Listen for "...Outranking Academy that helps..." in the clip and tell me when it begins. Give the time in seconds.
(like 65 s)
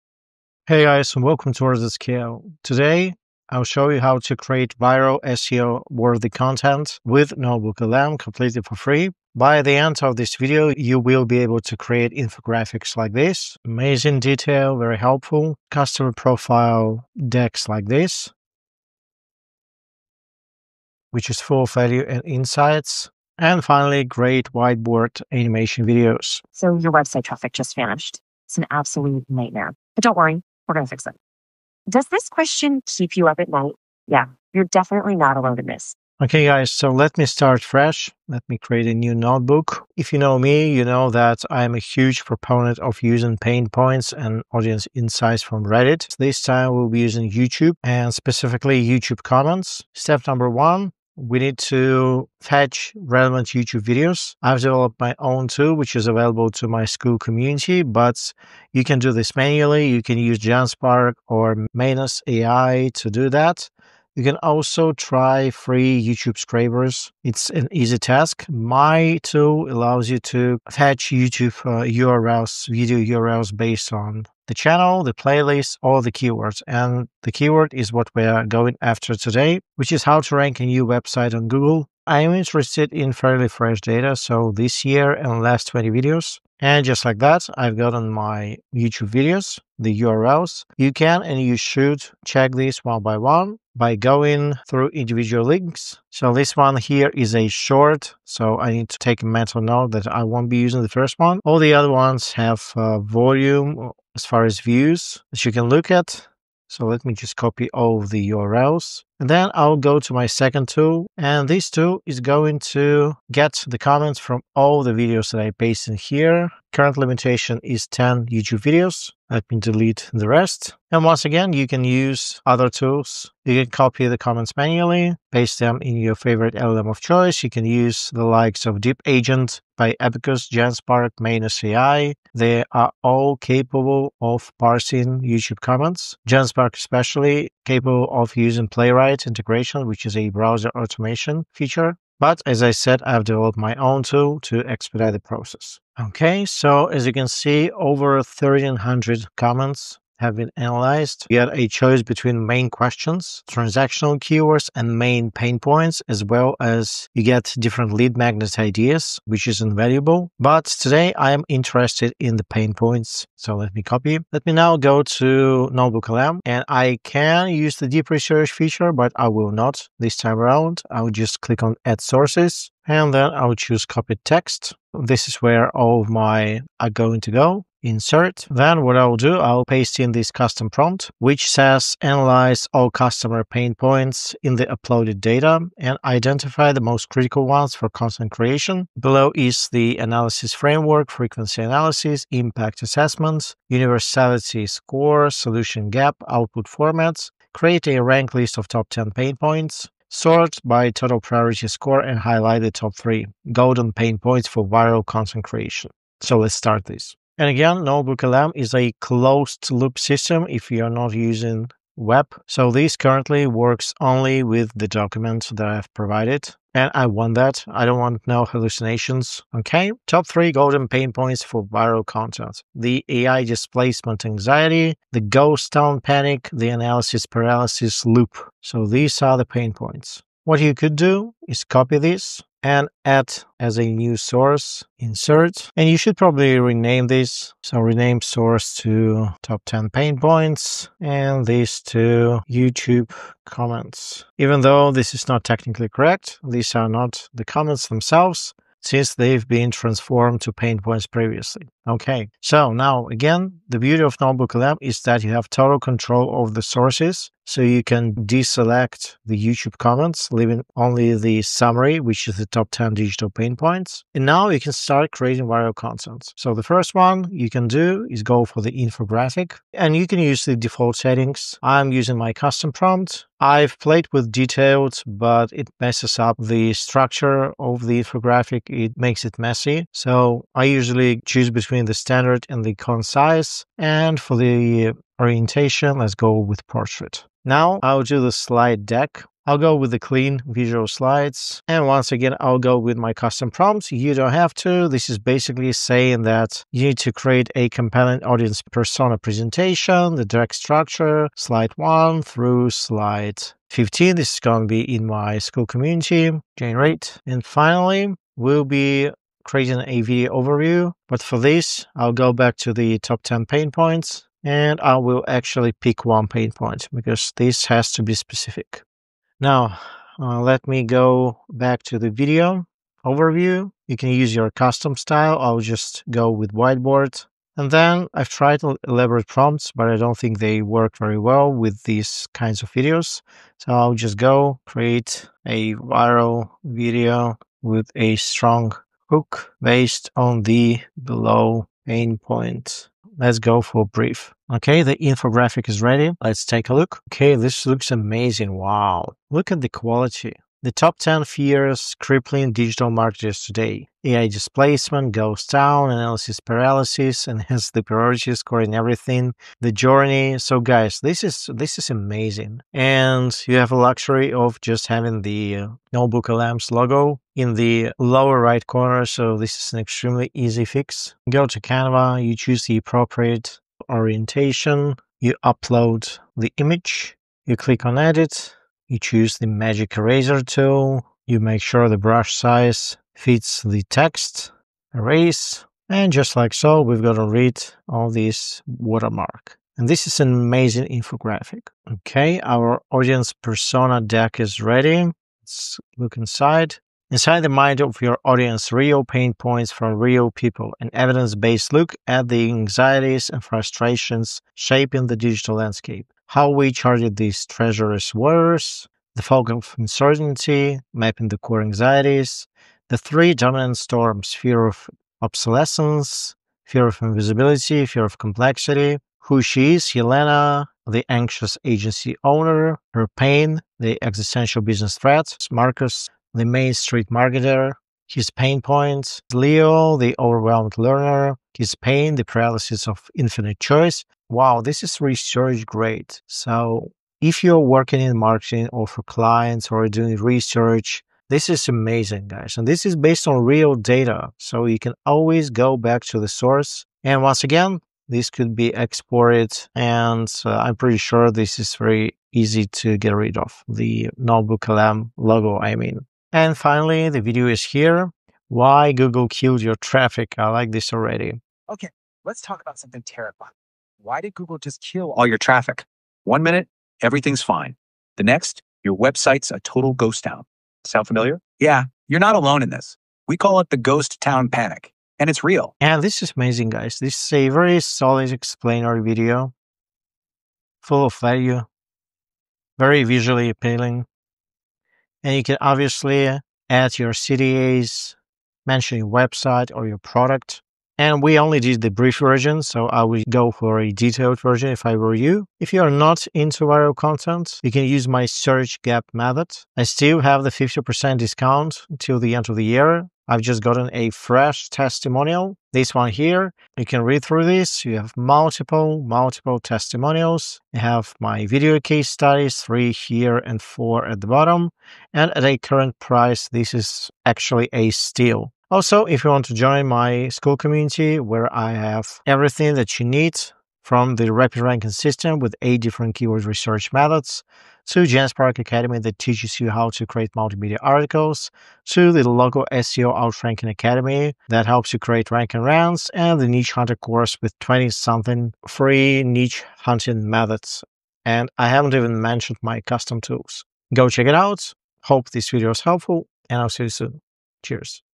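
533 s.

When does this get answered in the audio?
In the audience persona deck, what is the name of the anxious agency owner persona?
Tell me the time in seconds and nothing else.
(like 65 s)
419 s.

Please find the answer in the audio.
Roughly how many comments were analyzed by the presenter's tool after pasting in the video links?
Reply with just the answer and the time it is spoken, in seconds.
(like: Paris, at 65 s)
over 1300, at 147 s.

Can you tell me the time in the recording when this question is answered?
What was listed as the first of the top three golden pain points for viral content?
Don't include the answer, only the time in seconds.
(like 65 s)
222 s.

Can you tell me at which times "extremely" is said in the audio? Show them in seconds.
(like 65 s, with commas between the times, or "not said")
369 s.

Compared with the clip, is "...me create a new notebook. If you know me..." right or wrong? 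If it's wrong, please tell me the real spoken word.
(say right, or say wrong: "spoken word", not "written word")
right.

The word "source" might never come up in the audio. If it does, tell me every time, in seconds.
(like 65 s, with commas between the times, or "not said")
171 s, 234 s, 238 s, 256 s, 446 s.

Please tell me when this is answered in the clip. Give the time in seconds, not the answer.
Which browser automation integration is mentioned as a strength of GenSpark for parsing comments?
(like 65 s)
138 s.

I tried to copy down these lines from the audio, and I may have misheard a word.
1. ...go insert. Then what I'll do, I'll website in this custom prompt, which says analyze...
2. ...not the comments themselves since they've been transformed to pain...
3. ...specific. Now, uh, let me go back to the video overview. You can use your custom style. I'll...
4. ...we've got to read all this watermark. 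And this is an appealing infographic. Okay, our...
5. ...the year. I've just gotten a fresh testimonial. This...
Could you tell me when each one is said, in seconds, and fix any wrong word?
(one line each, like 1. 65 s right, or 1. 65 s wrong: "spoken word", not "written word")
1. 177 s wrong: "paste", not "website"
2. 246 s right
3. 318 s right
4. 386 s wrong: "amazing", not "appealing"
5. 502 s right.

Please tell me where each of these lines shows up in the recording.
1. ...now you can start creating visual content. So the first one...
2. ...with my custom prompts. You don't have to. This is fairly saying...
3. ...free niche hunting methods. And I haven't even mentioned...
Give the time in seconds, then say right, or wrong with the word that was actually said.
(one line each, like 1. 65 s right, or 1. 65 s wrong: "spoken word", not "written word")
1. 264 s wrong: "viral", not "visual"
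2. 292 s wrong: "basically", not "fairly"
3. 538 s right.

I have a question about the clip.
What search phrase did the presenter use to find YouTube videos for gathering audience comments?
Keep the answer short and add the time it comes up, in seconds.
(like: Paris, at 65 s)
how to rank a new website on Google, at 80 s.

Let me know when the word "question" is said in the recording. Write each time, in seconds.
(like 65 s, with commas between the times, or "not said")
32 s, 152 s.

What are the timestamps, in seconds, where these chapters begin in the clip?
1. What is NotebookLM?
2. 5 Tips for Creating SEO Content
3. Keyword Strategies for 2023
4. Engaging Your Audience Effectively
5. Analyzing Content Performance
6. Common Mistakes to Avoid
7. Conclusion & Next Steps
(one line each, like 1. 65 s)
1. 90 s
2. 165 s
3. 240 s
4. 320 s
5. 390 s
6. 480 s
7. 540 s.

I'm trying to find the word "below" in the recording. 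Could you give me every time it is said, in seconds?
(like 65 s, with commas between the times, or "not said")
188 s, 341 s.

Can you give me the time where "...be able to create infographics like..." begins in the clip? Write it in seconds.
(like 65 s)
11 s.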